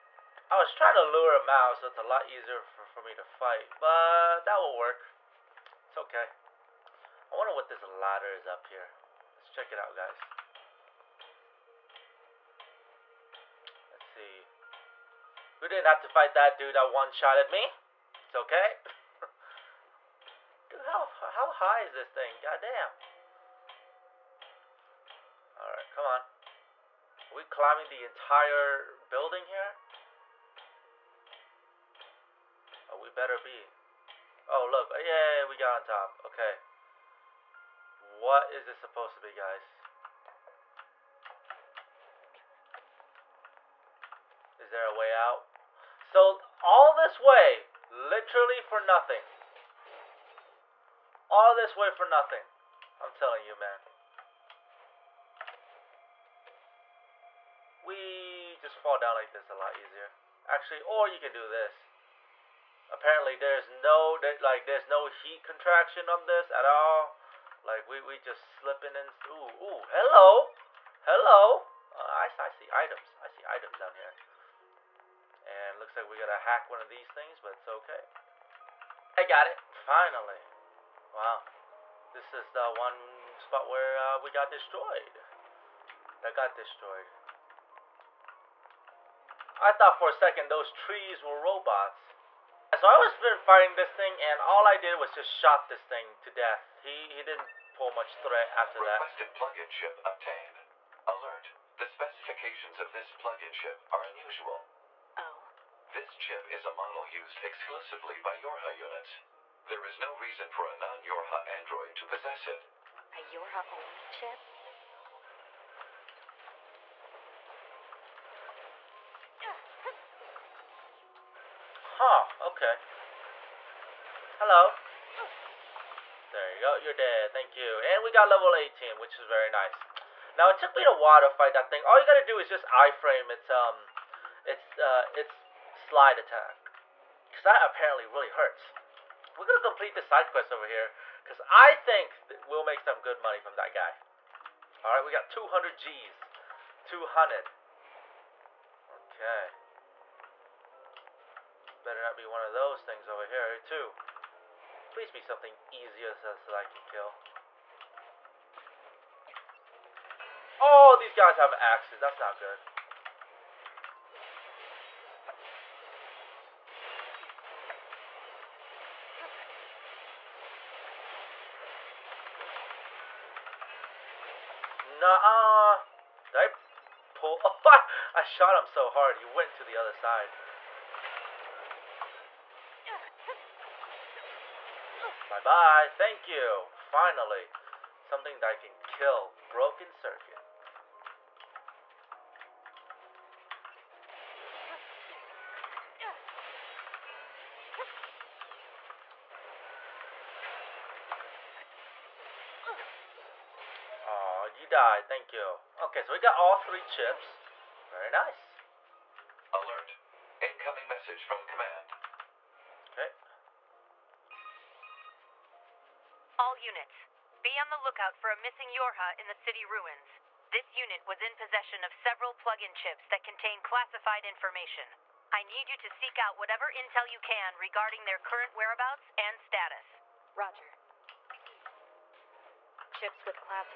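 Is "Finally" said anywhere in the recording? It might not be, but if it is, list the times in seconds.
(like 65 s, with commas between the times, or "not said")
79 s, 186 s.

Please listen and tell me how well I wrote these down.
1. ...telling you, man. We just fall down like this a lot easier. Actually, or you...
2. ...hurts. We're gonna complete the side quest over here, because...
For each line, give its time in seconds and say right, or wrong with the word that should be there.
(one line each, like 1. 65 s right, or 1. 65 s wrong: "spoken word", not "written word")
1. 53 s right
2. 138 s right.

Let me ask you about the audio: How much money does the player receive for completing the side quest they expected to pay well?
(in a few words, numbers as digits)
200 G.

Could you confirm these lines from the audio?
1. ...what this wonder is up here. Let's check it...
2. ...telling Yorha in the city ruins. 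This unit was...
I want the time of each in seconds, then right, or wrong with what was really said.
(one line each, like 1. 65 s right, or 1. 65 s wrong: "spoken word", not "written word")
1. 7 s wrong: "ladder", not "wonder"
2. 218 s wrong: "missing", not "telling".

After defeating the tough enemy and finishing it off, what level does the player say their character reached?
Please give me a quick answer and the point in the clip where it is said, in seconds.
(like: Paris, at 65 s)
18, at 128 s.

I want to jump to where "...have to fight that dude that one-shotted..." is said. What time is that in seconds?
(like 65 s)
15 s.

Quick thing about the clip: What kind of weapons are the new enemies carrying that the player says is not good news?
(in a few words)
Axes.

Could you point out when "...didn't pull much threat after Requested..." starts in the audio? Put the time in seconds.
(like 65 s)
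97 s.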